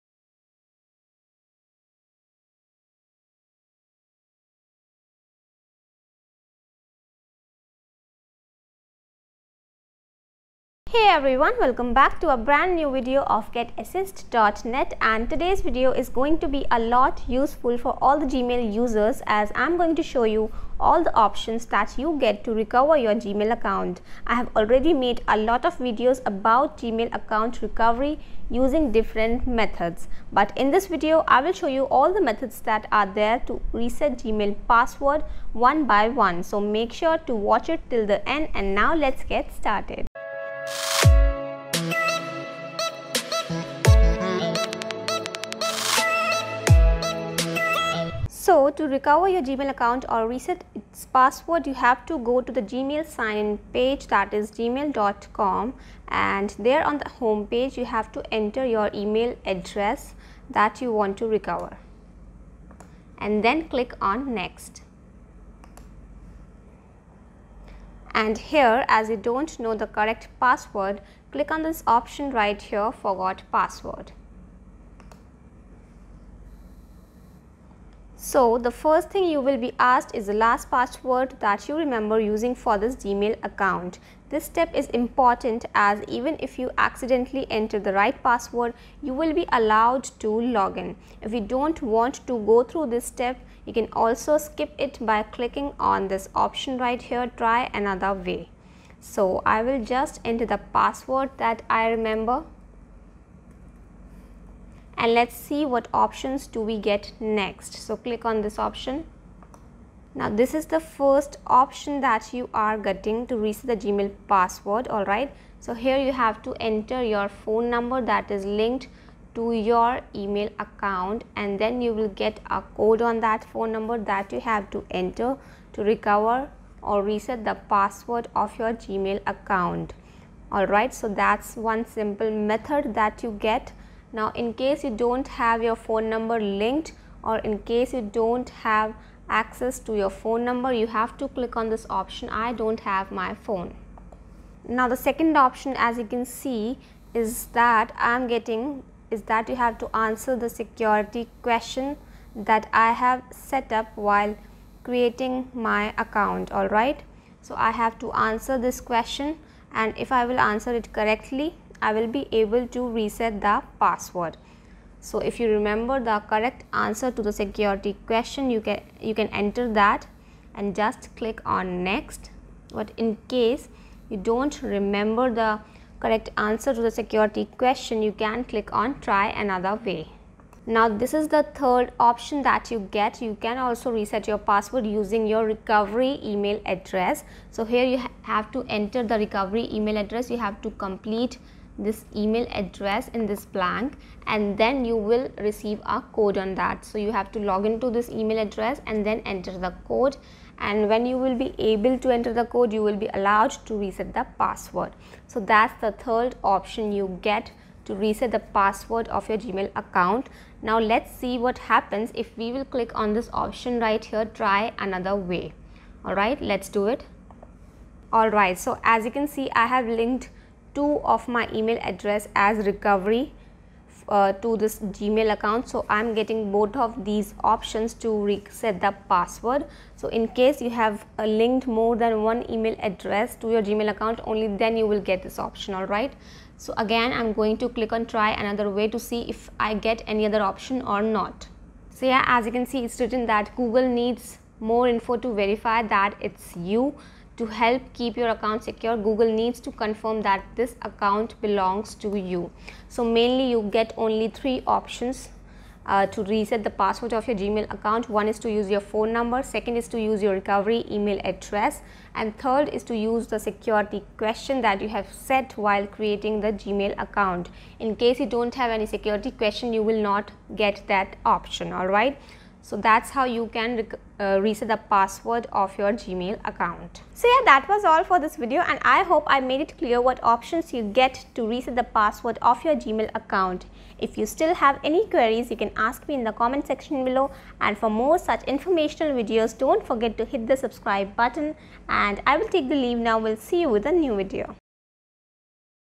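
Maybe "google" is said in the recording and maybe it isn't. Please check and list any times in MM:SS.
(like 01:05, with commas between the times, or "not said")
04:03, 04:09.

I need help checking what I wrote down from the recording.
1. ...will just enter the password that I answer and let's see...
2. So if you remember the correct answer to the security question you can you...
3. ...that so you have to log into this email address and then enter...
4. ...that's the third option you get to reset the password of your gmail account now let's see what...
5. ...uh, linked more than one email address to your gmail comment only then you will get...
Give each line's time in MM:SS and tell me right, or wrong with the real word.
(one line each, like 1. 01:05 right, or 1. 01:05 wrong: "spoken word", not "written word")
1. 01:39 wrong: "remember", not "answer"
2. 02:44 right
3. 03:16 right
4. 03:25 right
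5. 03:51 wrong: "account", not "comment".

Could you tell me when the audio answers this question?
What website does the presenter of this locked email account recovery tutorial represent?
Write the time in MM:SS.
00:13.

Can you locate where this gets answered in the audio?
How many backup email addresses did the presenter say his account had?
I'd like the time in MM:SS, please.
03:40.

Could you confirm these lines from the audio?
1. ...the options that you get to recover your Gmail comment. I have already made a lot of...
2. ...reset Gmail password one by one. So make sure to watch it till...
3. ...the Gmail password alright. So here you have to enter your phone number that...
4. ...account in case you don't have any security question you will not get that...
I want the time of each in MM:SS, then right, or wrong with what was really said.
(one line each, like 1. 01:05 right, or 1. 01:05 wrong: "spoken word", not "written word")
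1. 00:21 wrong: "account", not "comment"
2. 00:33 right
3. 01:53 right
4. 04:27 right.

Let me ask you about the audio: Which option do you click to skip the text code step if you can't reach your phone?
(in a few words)
I don't have my phone.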